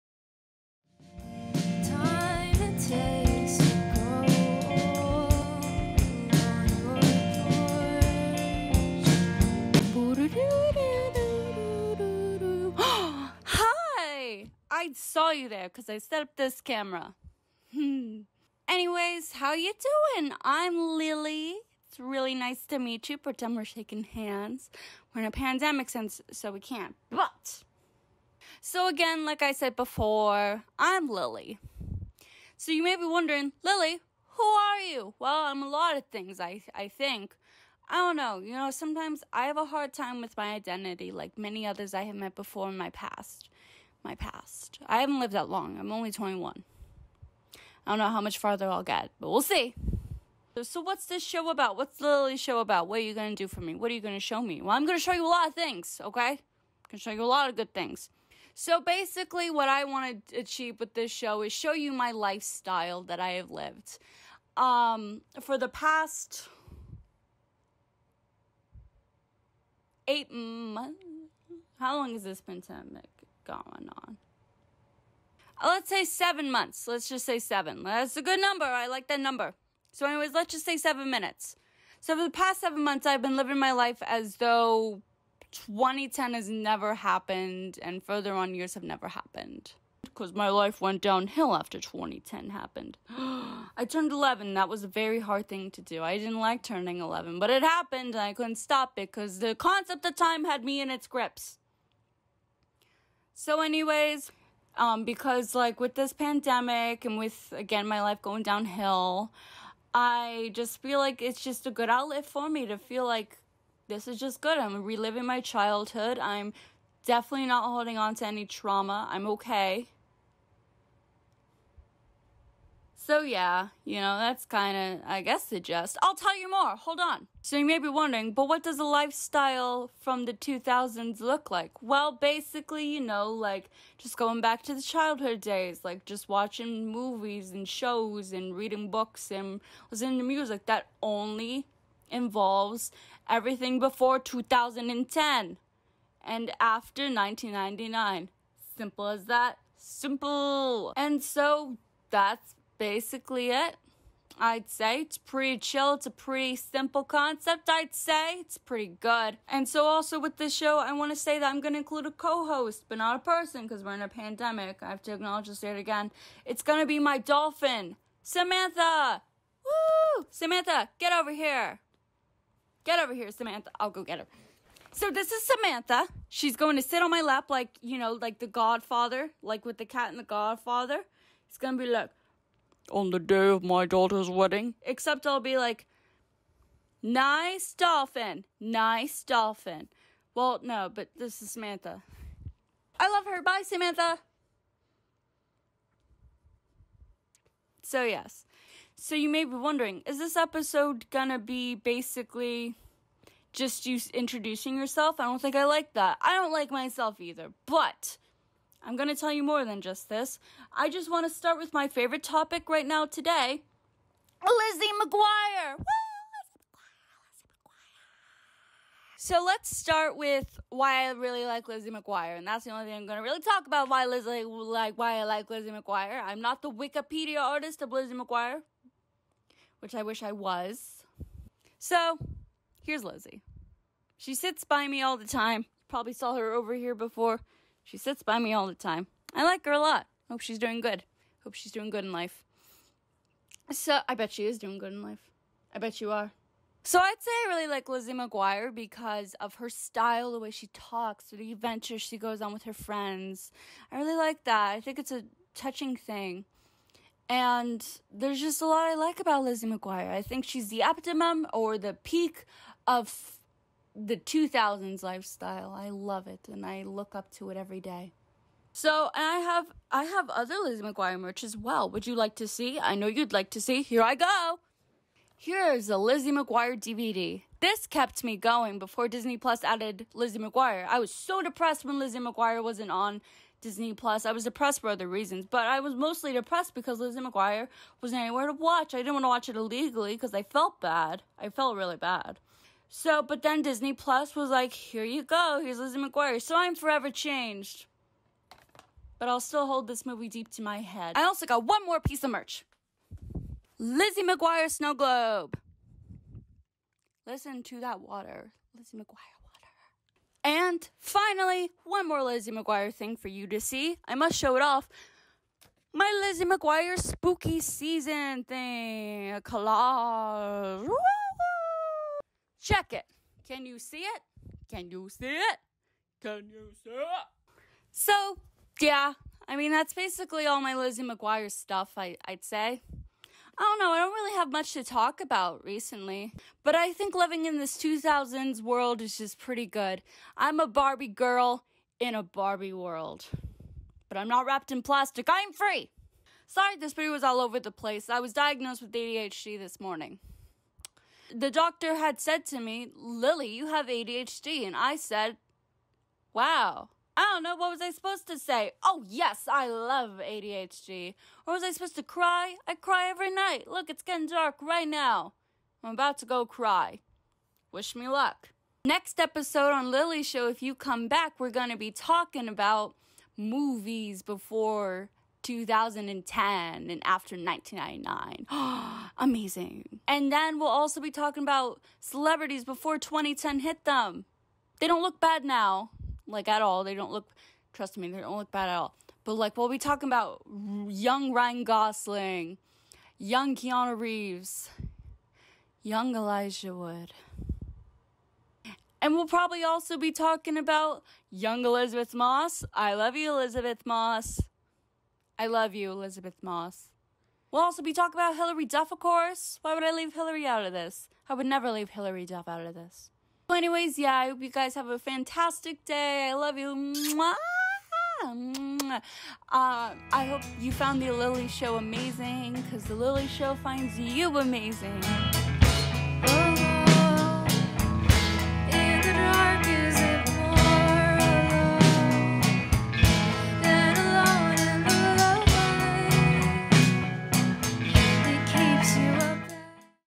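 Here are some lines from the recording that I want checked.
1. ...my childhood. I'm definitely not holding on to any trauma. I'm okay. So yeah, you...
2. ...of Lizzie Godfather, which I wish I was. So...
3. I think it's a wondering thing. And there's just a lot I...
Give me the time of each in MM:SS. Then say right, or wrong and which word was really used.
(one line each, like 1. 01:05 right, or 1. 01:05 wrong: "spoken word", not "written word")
1. 01:55 right
2. 03:47 wrong: "McGuire", not "Godfather"
3. 04:14 wrong: "touching", not "wondering".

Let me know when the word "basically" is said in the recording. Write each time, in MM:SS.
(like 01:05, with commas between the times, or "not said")
00:58, 02:12, 02:32, 03:21, 05:29.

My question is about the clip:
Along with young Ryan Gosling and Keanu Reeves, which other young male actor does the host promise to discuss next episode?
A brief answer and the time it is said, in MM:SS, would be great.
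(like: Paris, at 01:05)
Elijah Wood, at 06:36.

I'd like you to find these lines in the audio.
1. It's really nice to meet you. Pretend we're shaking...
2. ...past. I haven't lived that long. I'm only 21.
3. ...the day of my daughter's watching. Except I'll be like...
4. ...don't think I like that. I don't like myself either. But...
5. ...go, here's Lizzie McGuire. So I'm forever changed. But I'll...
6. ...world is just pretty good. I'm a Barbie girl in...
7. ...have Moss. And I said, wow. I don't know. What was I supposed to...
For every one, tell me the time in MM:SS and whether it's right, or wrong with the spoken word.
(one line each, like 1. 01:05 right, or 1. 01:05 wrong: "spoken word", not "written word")
1. 00:21 right
2. 00:44 right
3. 03:03 wrong: "wedding", not "watching"
4. 03:25 right
5. 04:55 right
6. 05:38 right
7. 05:53 wrong: "ADHD", not "Moss".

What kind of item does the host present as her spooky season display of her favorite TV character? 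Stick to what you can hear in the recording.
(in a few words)
A collage.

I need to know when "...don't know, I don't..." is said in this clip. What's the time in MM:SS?
05:33.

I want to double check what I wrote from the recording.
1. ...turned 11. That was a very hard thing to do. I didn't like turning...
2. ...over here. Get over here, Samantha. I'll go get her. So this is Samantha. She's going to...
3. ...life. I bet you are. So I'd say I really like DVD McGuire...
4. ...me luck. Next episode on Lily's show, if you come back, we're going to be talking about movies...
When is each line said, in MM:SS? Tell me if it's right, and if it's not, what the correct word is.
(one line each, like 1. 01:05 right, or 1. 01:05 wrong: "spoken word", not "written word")
1. 01:33 right
2. 02:51 right
3. 04:05 wrong: "Lizzie", not "DVD"
4. 06:07 right.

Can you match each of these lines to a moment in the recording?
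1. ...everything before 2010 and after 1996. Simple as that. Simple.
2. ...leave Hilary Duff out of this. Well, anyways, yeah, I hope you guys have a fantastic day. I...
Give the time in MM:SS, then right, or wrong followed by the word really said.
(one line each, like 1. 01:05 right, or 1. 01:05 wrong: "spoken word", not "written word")
1. 02:23 wrong: "1999", not "1996"
2. 06:51 right.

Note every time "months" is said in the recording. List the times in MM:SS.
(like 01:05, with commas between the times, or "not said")
01:10, 01:16, 01:22.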